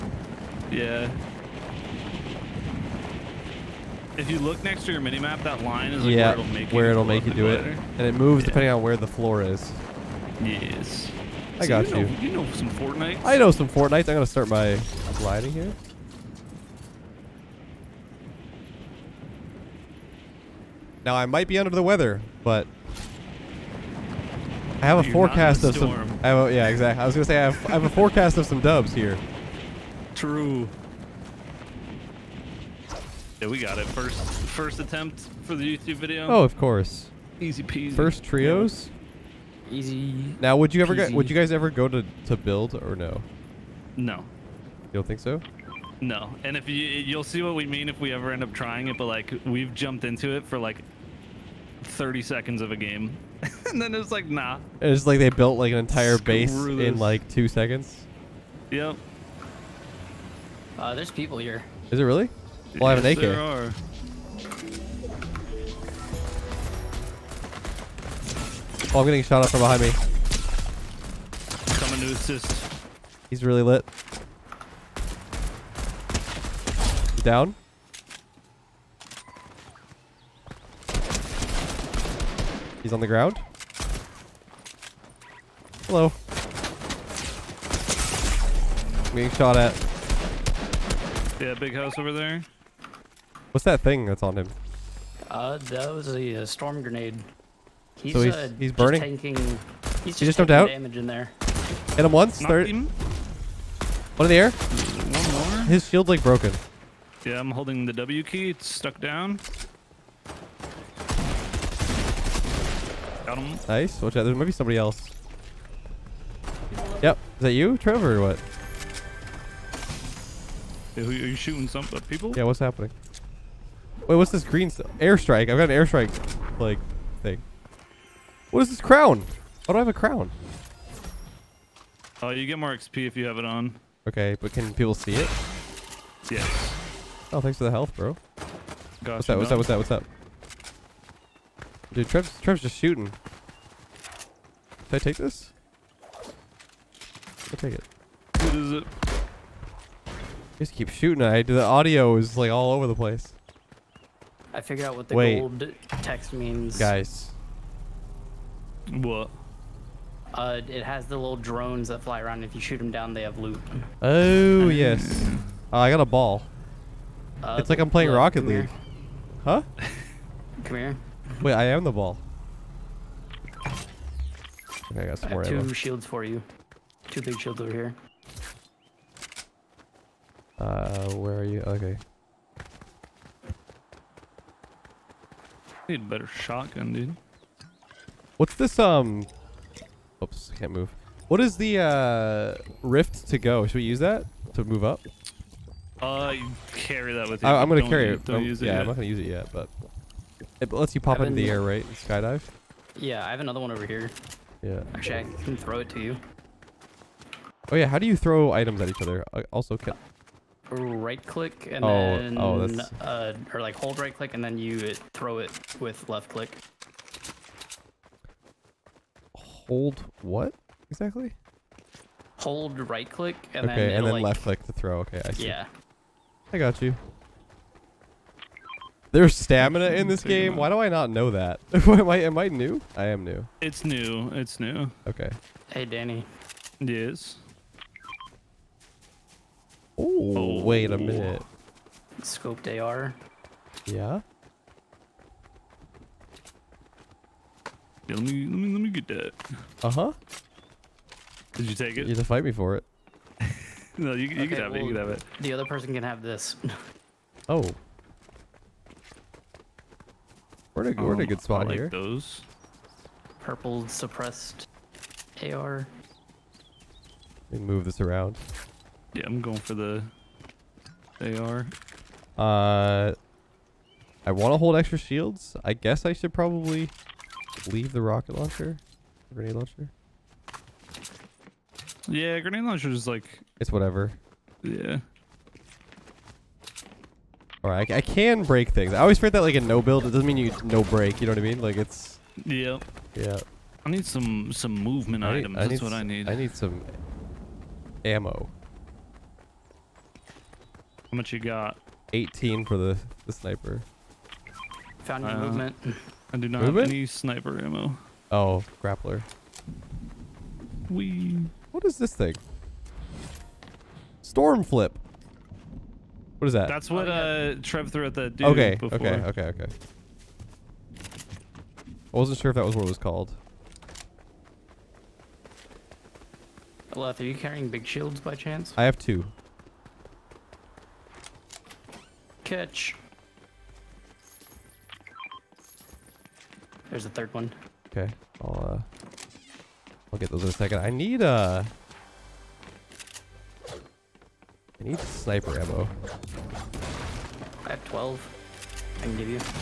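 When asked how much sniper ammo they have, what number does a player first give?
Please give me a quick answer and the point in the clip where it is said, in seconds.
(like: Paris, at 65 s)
18, at 302 s.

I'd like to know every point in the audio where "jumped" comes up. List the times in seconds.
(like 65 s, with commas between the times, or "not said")
49 s, 100 s.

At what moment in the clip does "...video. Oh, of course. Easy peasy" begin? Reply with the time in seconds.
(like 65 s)
35 s.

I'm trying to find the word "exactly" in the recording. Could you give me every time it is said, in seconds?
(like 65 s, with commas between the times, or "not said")
26 s, 220 s.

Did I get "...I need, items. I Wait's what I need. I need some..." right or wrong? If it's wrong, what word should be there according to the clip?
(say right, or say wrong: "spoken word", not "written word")
wrong: "That", not "Wait".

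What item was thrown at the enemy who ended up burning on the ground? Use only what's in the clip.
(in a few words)
storm grenade.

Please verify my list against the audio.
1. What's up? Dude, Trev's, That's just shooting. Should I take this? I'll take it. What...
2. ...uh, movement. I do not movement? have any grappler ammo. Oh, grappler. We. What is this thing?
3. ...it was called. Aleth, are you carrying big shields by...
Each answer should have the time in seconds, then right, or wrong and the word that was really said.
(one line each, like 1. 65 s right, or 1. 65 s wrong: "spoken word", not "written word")
1. 139 s wrong: "Trev", not "That"
2. 305 s wrong: "sniper", not "grappler"
3. 322 s right.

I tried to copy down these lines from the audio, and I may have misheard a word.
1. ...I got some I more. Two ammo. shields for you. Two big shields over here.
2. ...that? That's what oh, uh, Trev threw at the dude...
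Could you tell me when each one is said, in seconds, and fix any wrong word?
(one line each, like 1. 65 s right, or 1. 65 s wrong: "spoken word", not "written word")
1. 175 s right
2. 316 s right.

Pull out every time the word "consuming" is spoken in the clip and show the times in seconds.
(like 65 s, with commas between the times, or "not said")
not said.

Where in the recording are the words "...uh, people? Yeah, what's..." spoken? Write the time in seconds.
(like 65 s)
121 s.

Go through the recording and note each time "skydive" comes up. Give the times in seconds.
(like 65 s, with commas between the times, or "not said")
201 s.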